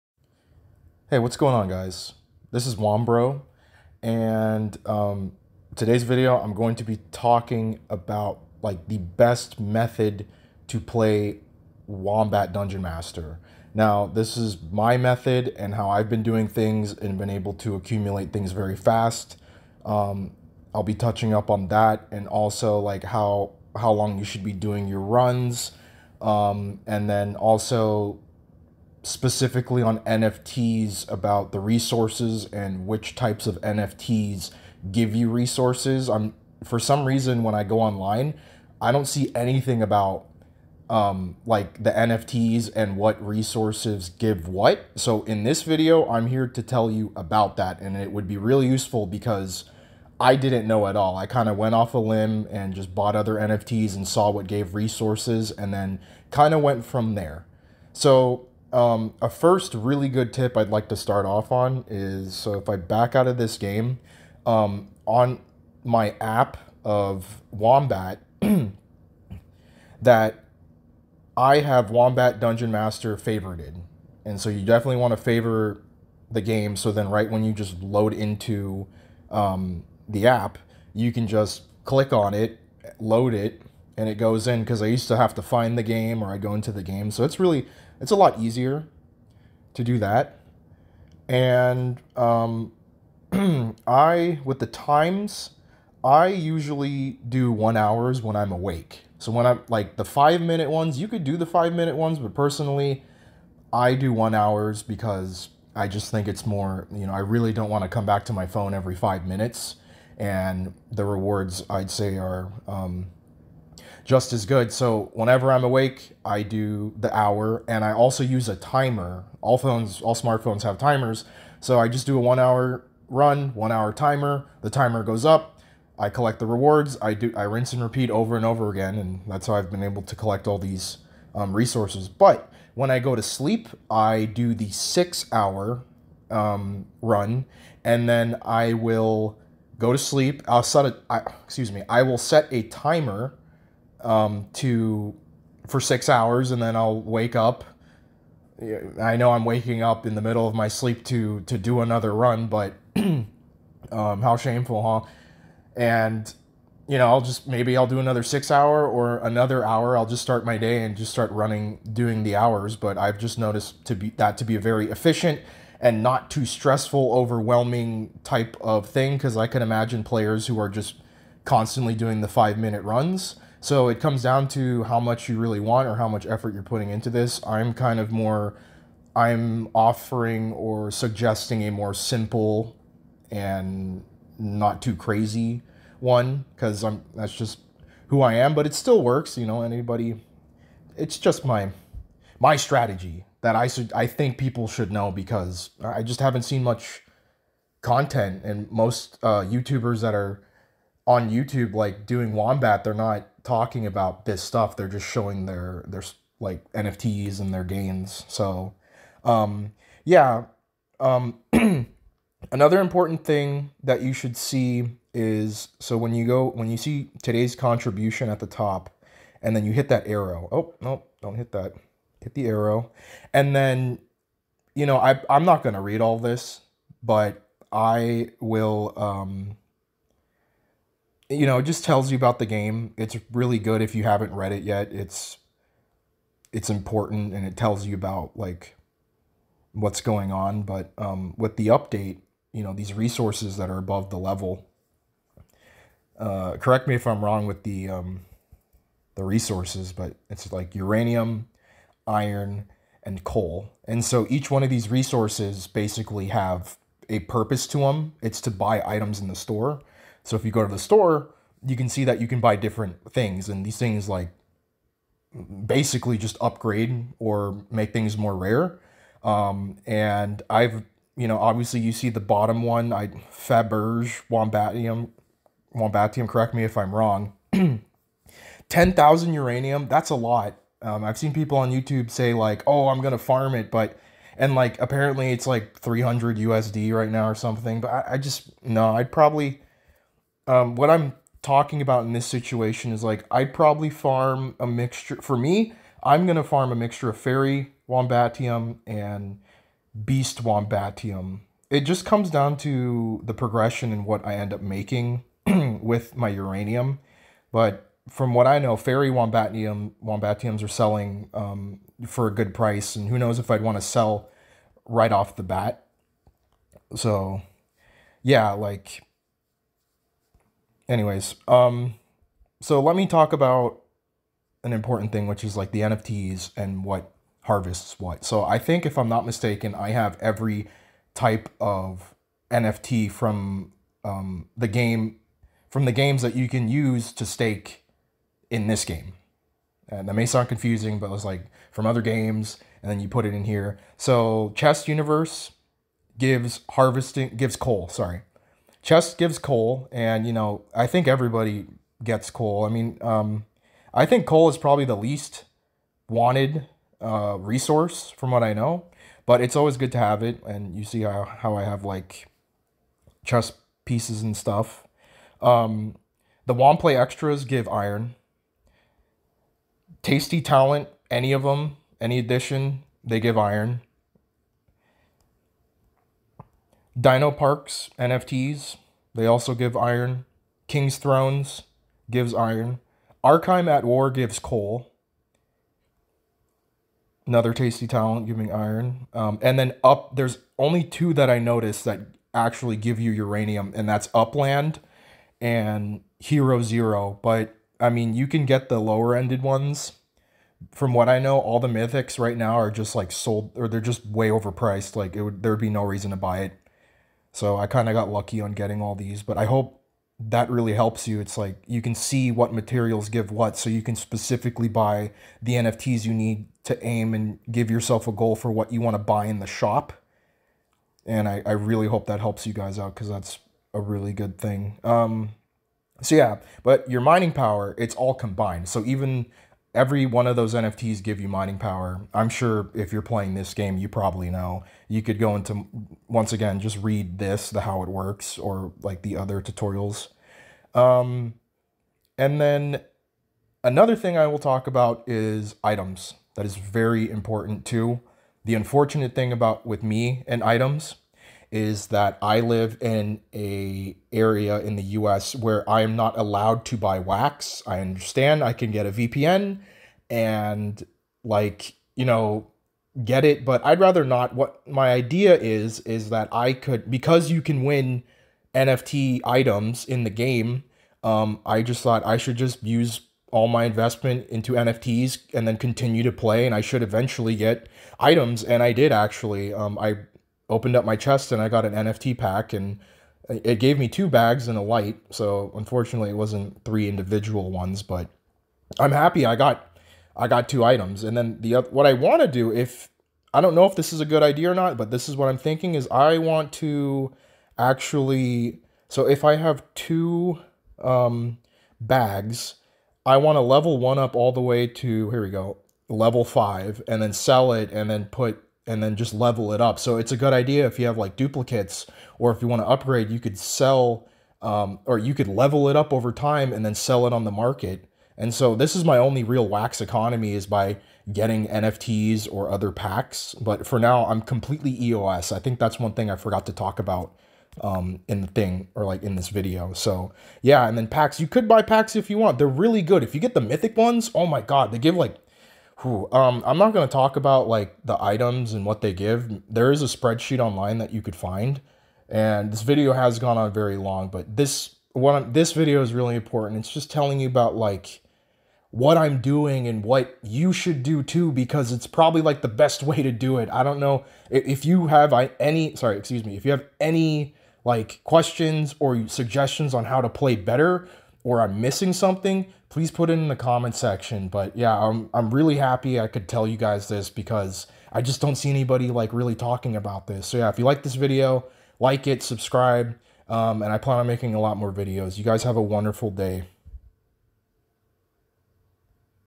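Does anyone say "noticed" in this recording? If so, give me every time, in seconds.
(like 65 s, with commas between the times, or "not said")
163 s, 391 s.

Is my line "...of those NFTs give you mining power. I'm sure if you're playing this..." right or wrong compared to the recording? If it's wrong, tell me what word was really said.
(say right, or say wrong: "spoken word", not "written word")
right.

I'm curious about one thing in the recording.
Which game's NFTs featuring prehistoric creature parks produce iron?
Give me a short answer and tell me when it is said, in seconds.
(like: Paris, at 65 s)
Dino Parks, at 376 s.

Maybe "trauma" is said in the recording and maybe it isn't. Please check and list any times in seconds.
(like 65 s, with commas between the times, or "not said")
not said.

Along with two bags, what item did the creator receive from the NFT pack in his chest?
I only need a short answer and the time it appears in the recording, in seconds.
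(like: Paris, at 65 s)
a light, at 484 s.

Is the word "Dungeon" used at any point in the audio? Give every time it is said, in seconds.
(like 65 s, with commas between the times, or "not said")
12 s, 72 s.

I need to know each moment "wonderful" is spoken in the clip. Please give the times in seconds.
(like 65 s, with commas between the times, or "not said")
575 s.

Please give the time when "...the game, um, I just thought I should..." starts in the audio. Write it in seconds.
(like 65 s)
470 s.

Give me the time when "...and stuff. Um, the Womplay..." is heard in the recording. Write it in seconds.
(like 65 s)
364 s.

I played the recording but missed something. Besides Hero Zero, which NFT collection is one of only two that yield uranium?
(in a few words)
Upland.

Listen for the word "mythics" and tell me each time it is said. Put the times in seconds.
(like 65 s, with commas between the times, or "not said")
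401 s, 533 s.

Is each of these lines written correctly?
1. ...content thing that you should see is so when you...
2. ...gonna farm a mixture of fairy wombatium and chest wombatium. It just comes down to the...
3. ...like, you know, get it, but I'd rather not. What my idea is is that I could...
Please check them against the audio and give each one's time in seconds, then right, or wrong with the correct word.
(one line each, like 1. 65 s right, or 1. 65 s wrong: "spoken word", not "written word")
1. 212 s wrong: "important", not "content"
2. 296 s wrong: "beast", not "chest"
3. 461 s right.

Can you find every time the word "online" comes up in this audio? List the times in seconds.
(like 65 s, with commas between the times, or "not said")
37 s, 540 s.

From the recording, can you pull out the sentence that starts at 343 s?
So Chest Universe gives harvesting, gives coal, sorry, Chess gives coal, and you know, I think everybody gets coal.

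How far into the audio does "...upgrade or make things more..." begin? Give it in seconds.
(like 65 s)
266 s.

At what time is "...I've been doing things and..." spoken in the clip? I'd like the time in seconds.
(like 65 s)
15 s.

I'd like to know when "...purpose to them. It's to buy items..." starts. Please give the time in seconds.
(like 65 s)
257 s.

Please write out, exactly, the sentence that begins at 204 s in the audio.
They're just showing their their like NFTs and their gains.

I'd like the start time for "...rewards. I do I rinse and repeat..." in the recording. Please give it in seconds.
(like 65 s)
126 s.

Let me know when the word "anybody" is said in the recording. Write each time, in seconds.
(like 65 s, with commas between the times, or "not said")
189 s, 568 s.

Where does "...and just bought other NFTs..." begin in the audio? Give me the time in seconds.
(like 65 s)
52 s.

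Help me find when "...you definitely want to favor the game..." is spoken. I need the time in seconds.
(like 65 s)
74 s.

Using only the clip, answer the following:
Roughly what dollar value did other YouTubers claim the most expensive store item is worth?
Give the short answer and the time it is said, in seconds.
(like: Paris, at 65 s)
300 USD, at 285 s.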